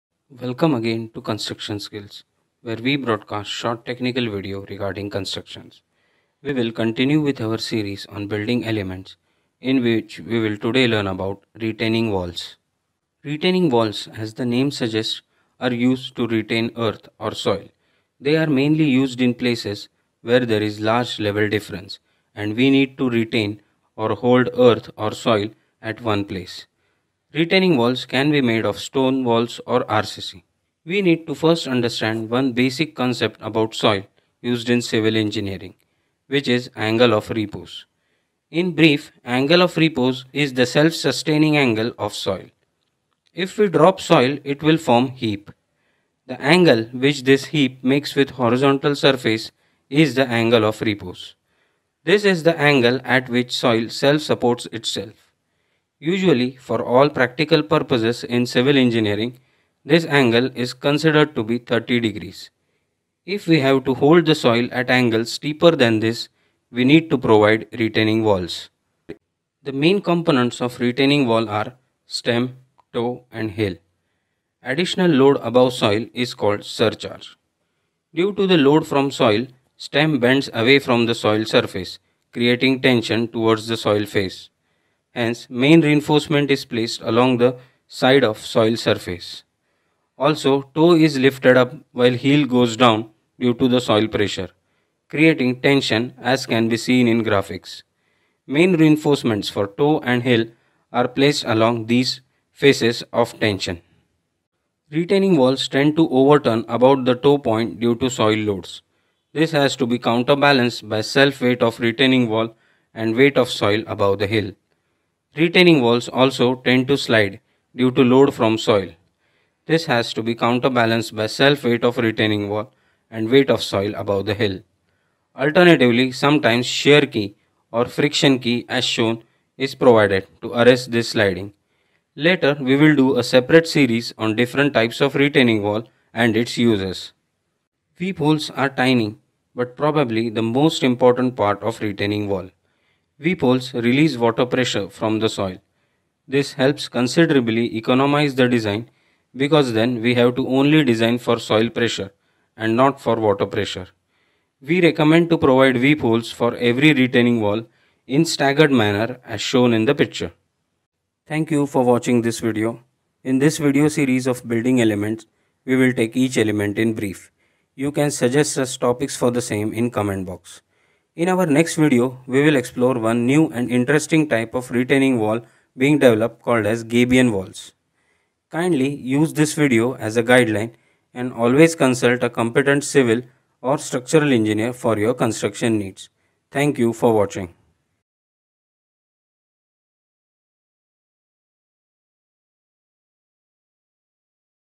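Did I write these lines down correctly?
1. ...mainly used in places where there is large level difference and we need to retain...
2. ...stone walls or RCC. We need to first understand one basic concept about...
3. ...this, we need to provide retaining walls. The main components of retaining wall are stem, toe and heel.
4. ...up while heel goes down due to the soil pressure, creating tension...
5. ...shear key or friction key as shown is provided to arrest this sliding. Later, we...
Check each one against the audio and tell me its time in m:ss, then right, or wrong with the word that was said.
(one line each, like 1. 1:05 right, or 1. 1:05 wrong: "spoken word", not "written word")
1. 0:18 right
2. 0:28 right
3. 1:05 right
4. 1:31 right
5. 2:06 right.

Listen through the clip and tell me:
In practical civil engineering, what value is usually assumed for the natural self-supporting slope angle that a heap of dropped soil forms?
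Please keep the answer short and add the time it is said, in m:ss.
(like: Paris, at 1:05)
30 degrees, at 1:01.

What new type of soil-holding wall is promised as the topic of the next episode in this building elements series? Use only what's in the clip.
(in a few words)
Gabion walls.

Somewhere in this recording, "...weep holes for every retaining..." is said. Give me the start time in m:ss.
2:35.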